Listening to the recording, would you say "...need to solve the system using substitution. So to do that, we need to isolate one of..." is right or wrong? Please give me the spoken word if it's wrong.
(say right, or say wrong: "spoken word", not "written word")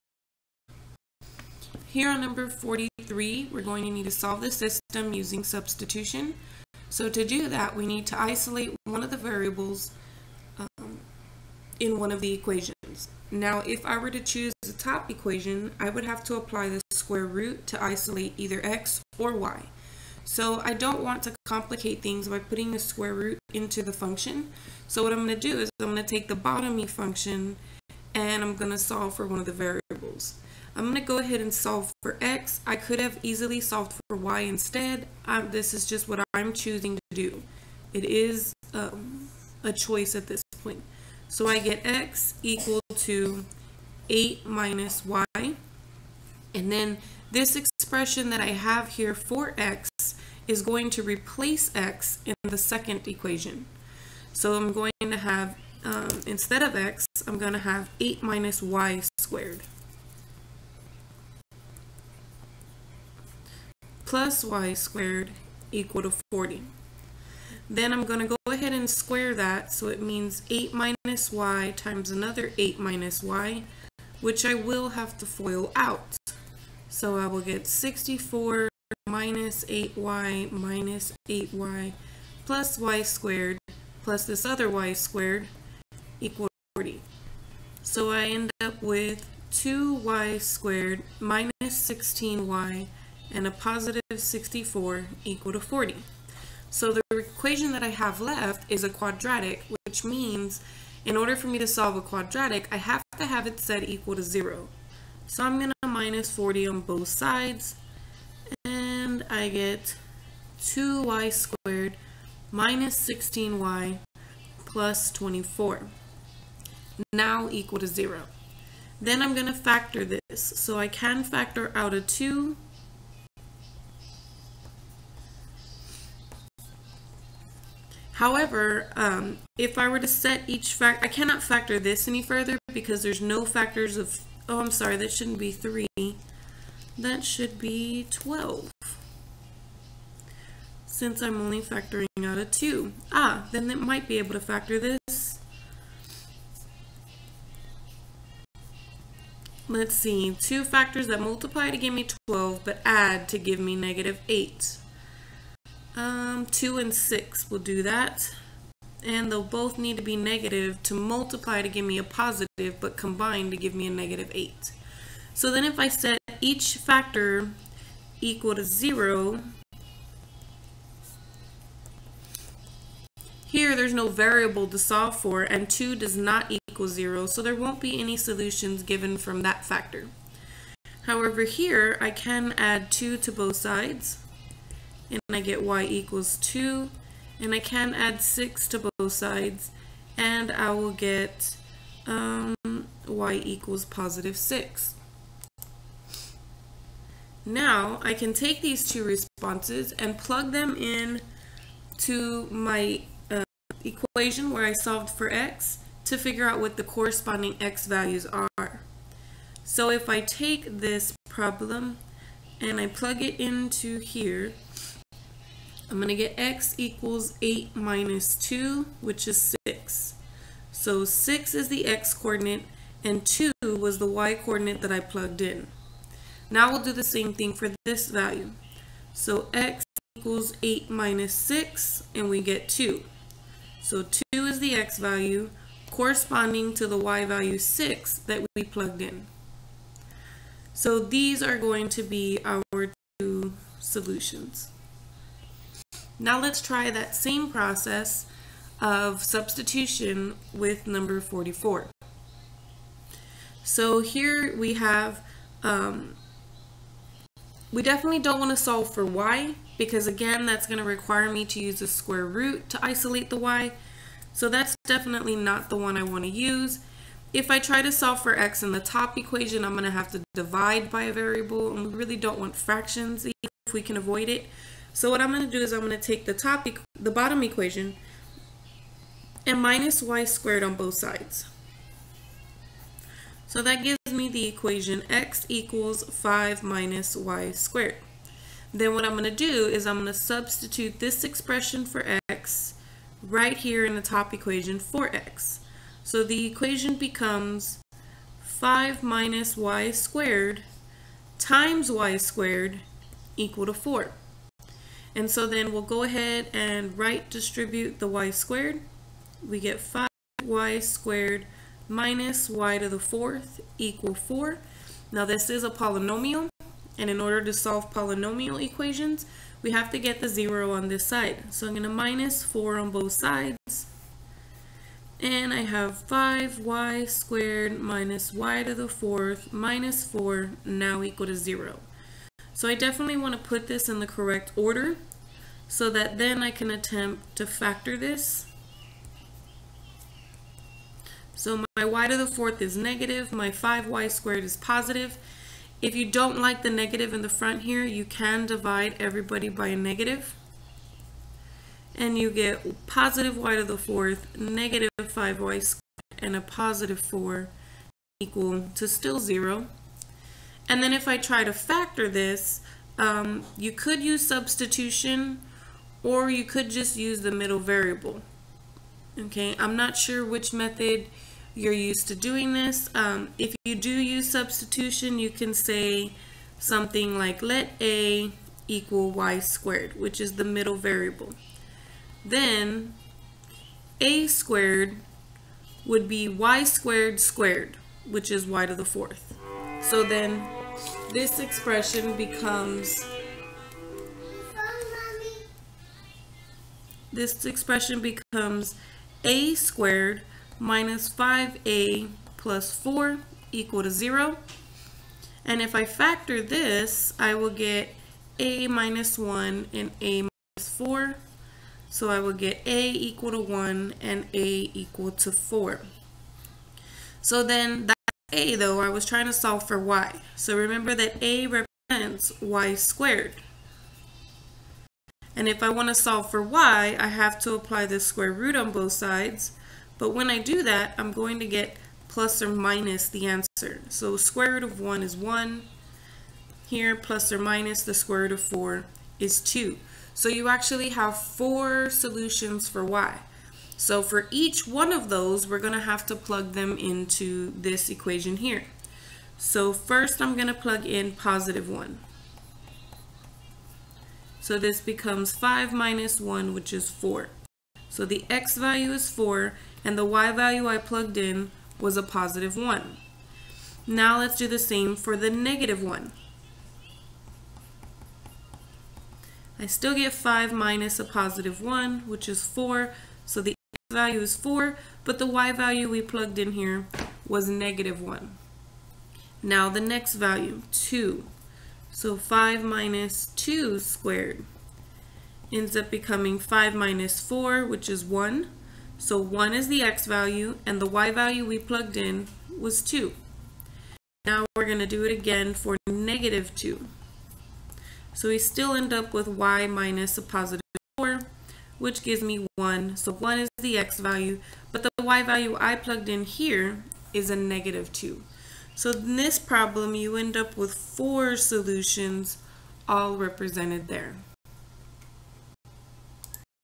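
right.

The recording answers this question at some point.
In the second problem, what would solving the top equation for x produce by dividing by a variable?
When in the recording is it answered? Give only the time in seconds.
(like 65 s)
272 s.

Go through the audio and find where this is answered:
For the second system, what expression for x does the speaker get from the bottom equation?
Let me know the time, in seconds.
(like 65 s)
285 s.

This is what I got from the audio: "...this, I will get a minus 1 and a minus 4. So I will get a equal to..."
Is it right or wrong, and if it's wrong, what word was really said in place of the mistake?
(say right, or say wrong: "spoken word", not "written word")
right.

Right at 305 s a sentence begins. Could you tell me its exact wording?
And so then we'll go ahead and right distribute the y squared.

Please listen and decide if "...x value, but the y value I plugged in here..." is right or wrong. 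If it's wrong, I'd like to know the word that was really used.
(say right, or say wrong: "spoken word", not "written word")
right.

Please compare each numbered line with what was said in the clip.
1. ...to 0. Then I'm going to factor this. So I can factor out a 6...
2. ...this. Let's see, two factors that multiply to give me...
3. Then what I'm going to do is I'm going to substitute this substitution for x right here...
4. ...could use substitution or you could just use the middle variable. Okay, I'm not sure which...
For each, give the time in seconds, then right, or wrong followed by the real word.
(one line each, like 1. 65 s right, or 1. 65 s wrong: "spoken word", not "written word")
1. 117 s wrong: "2", not "6"
2. 144 s right
3. 288 s wrong: "expression", not "substitution"
4. 363 s right.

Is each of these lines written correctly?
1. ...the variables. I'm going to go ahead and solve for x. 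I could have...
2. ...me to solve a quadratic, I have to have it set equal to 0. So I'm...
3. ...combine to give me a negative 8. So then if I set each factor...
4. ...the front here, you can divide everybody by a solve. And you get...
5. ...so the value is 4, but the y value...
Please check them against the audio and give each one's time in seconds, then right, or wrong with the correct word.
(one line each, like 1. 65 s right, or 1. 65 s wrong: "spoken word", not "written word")
1. 29 s right
2. 101 s right
3. 162 s right
4. 347 s wrong: "negative", not "solve"
5. 473 s right.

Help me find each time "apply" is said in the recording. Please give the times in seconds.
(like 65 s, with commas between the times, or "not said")
16 s, 427 s.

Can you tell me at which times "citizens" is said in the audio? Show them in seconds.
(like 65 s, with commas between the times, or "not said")
not said.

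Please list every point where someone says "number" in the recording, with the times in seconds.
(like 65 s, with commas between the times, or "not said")
2 s, 250 s.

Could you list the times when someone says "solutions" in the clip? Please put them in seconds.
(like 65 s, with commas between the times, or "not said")
178 s, 243 s, 441 s, 511 s.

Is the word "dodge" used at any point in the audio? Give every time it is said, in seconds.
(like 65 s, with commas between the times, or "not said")
not said.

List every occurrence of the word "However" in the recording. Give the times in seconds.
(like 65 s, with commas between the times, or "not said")
128 s, 181 s.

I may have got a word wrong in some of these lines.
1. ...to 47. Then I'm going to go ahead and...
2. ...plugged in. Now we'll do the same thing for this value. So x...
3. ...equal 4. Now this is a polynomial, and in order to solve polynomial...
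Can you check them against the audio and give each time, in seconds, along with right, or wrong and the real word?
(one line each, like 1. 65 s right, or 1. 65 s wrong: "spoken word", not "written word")
1. 66 s wrong: "40", not "47"
2. 225 s right
3. 313 s right.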